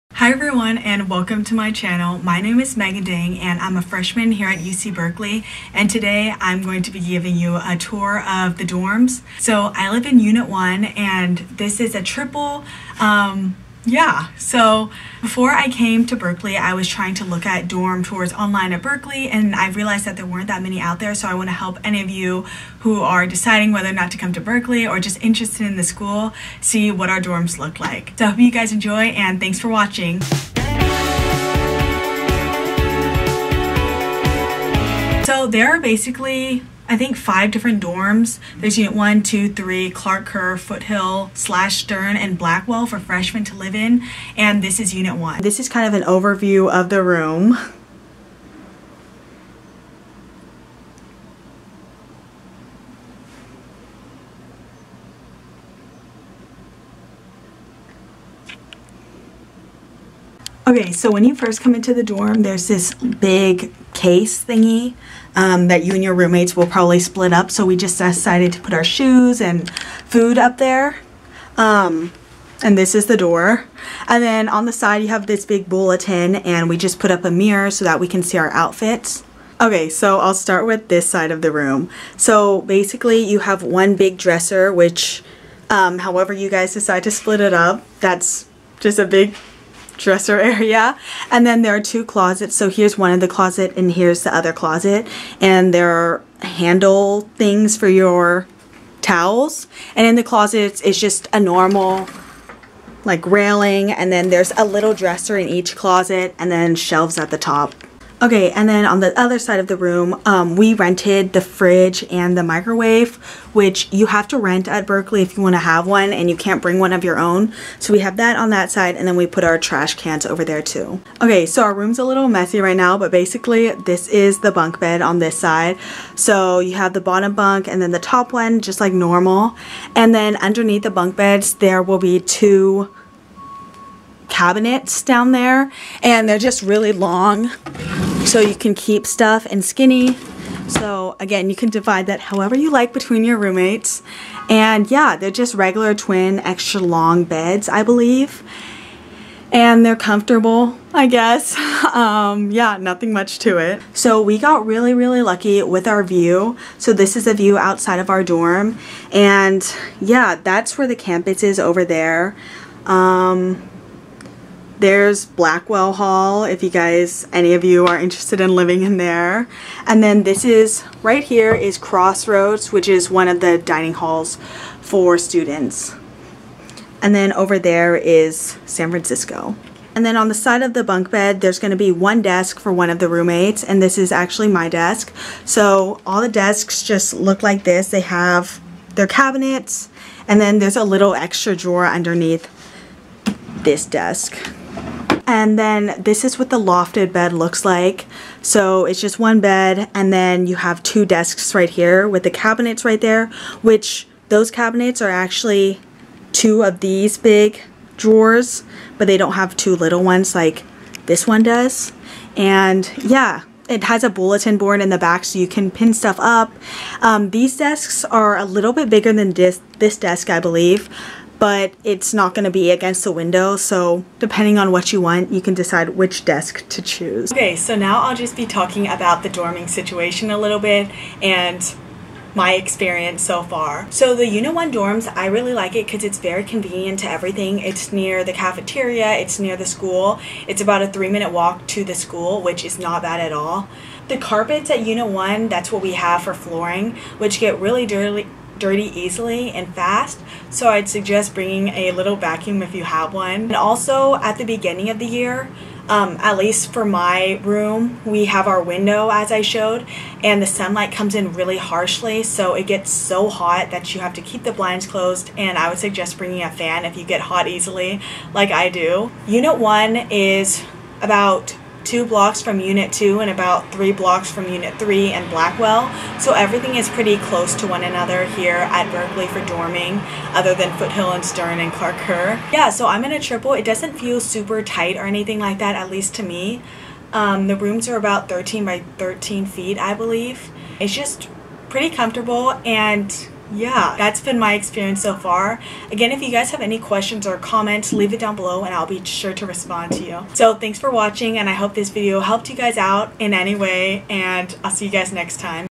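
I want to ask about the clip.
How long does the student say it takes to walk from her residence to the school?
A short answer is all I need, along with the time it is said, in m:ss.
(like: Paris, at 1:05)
3 minutes, at 4:00.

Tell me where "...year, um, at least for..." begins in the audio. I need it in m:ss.
4:15.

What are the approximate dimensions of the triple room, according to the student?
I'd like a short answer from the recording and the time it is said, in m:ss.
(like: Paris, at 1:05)
13 by 13 feet, at 4:48.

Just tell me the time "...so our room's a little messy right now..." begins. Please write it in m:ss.
2:01.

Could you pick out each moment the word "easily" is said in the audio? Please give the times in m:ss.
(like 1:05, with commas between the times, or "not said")
4:08, 4:27.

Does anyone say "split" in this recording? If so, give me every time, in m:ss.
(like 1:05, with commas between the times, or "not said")
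1:06, 1:27.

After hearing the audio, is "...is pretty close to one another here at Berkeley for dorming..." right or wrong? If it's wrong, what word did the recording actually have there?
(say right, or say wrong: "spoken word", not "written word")
right.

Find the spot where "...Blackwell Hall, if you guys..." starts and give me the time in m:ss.
2:45.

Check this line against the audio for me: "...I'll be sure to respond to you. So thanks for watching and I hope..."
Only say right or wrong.
right.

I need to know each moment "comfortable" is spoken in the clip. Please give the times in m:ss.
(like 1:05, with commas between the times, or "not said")
2:29, 4:51.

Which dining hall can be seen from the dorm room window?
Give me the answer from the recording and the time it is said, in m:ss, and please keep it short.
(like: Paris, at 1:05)
Crossroads, at 2:51.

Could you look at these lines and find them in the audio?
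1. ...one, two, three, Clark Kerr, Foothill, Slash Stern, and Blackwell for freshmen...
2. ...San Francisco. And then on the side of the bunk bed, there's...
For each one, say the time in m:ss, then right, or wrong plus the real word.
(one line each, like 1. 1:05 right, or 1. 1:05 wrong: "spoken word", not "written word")
1. 0:38 right
2. 2:58 right.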